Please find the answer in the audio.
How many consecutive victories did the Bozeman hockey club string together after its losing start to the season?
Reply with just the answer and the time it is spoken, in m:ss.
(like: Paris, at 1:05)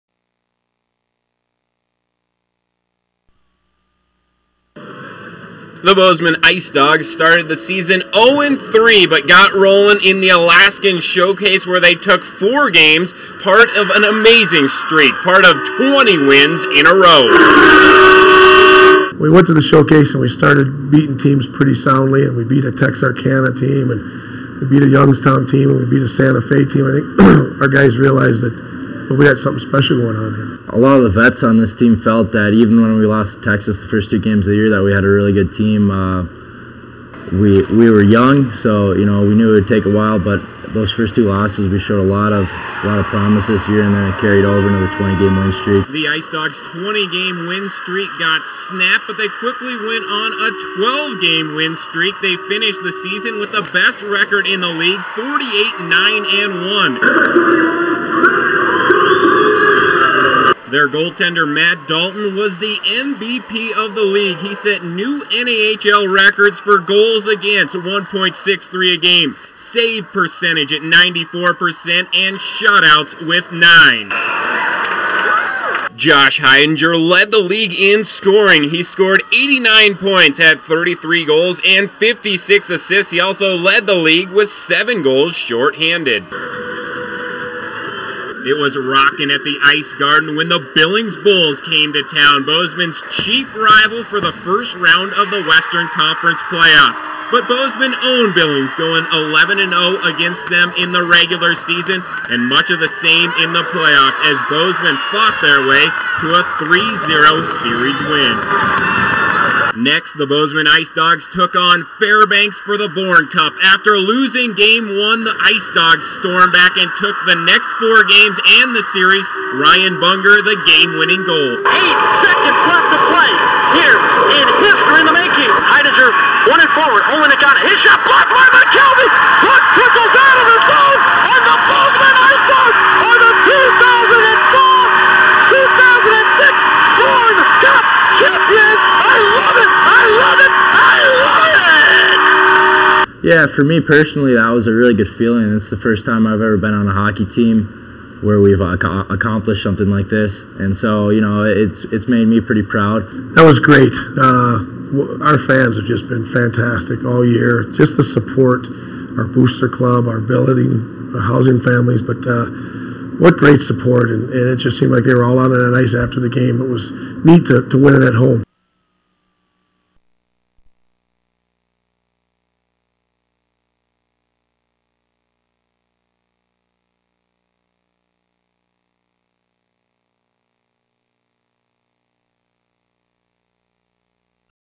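20, at 0:15.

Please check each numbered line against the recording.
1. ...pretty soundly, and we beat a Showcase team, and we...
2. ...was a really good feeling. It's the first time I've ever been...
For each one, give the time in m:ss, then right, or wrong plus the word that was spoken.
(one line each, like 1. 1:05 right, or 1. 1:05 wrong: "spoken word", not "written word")
1. 0:21 wrong: "Texarkana", not "Showcase"
2. 2:24 right.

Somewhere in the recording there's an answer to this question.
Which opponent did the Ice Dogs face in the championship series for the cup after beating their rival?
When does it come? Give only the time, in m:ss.
1:51.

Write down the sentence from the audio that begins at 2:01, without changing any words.
Eight seconds left to play here in history in the making.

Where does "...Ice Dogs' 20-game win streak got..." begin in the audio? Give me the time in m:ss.
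0:46.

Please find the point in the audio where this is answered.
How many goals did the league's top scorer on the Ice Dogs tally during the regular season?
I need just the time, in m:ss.
1:20.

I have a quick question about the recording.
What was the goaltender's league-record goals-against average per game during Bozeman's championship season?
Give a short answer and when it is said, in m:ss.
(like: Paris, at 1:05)
1.63, at 1:07.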